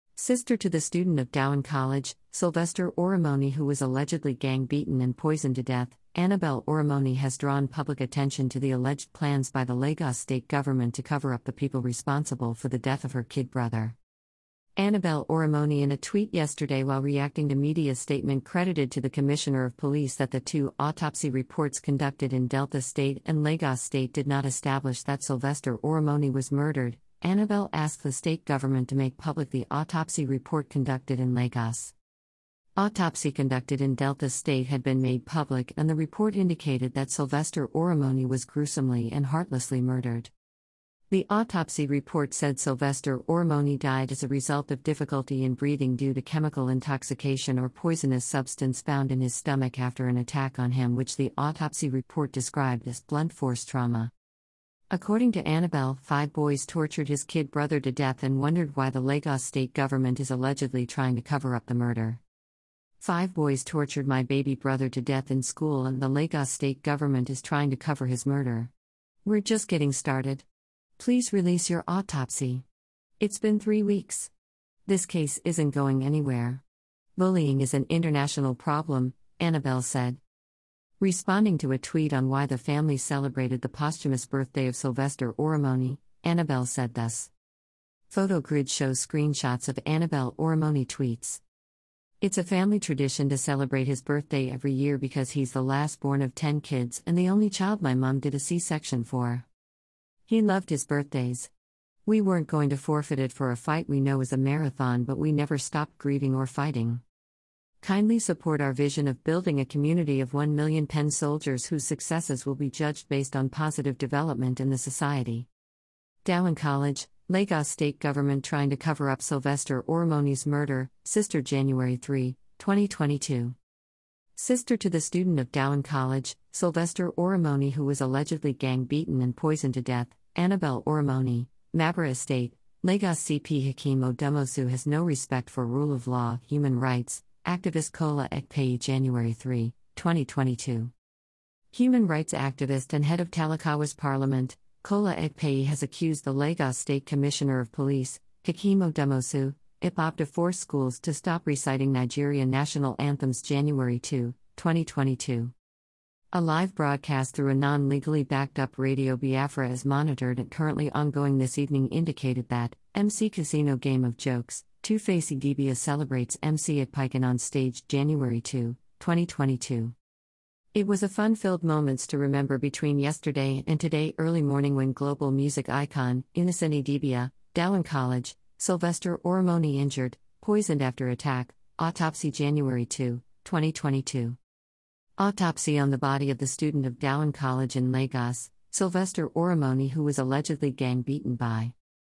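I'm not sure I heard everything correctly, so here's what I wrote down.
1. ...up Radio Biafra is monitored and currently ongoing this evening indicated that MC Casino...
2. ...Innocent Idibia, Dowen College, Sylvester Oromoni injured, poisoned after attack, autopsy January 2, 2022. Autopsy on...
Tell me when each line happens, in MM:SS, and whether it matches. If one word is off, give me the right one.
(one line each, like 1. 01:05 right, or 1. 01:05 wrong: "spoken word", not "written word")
1. 02:38 right
2. 02:56 right.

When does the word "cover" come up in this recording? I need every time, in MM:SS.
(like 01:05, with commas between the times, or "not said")
00:11, 01:01, 01:07, 01:58.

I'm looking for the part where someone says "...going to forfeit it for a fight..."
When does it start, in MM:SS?
01:42.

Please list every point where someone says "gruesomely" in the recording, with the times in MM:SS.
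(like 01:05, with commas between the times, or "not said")
00:38.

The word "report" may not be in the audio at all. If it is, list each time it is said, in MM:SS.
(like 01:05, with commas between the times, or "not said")
00:21, 00:30, 00:35, 00:41, 00:51.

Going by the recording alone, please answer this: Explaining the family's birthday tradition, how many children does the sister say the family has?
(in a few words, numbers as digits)
10.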